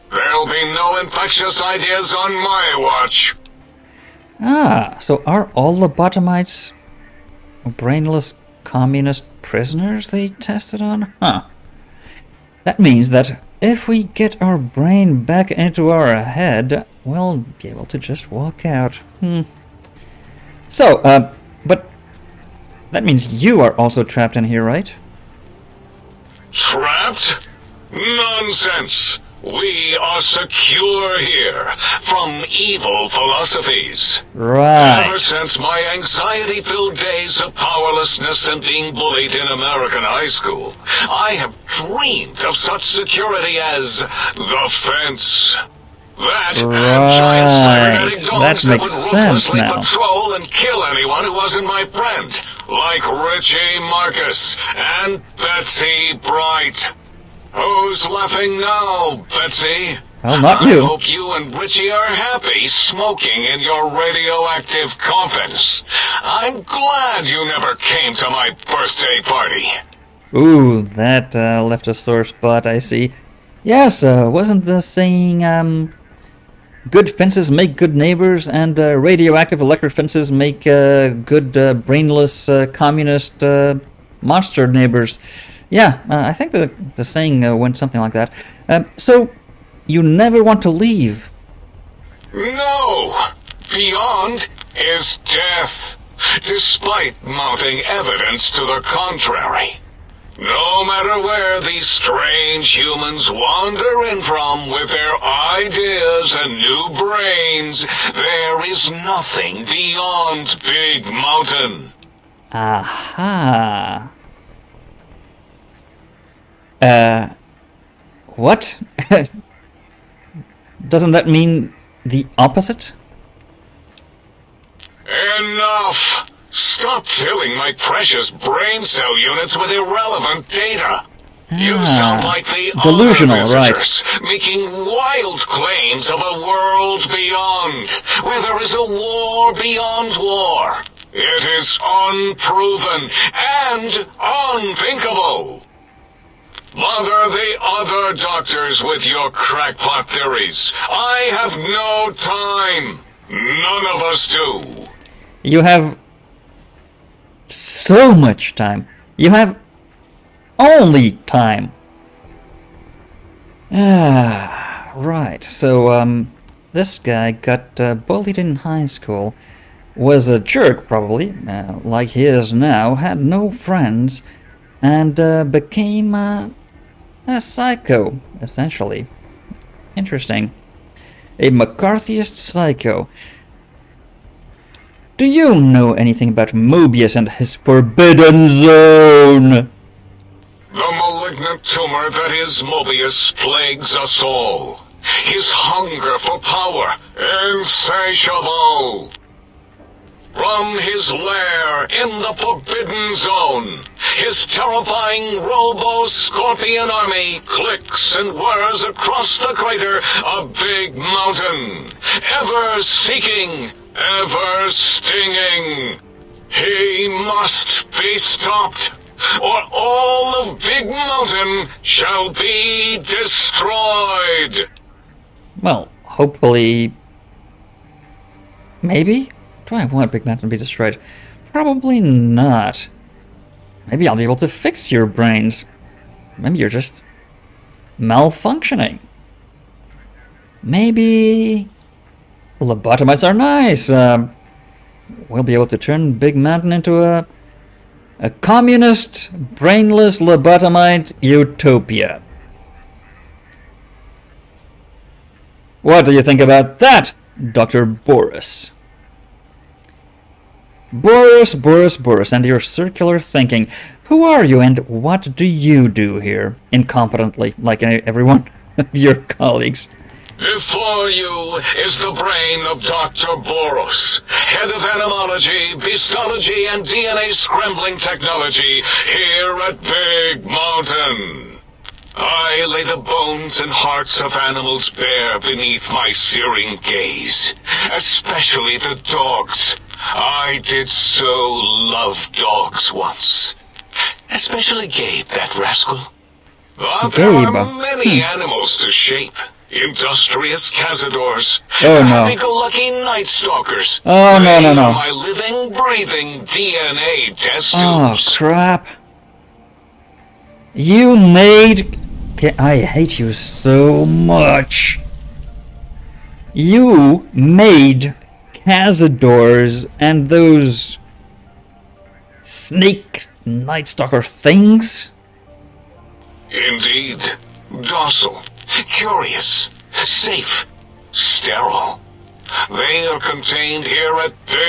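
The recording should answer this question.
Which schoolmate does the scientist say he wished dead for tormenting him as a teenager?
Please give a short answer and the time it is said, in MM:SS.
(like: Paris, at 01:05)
Betsy Bright, at 00:55.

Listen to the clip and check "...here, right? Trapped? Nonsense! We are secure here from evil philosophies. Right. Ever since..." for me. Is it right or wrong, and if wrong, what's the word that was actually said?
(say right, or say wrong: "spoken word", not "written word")
right.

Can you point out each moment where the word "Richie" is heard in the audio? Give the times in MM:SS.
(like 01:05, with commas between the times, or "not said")
00:53, 01:01.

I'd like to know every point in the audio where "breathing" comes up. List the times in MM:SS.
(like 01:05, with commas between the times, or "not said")
05:05.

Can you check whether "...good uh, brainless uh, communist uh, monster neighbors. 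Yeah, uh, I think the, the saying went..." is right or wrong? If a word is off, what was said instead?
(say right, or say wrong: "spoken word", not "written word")
right.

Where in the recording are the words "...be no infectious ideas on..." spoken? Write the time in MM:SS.
00:00.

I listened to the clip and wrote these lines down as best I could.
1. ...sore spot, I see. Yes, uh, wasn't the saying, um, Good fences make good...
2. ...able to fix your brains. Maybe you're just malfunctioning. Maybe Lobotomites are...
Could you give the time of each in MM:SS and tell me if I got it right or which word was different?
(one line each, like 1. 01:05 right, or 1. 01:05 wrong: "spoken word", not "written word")
1. 01:11 right
2. 03:54 right.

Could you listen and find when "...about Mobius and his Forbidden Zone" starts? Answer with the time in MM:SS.
03:06.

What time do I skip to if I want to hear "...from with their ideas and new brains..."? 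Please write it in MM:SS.
01:44.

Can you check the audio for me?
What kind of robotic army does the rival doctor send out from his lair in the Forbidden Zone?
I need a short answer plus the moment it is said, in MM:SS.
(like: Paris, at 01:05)
Robo-Scorpion army, at 03:25.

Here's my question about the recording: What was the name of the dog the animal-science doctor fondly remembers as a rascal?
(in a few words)
Gabe.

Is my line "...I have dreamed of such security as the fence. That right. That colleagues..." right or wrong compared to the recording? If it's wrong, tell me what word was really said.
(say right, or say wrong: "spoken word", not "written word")
wrong: "makes", not "colleagues".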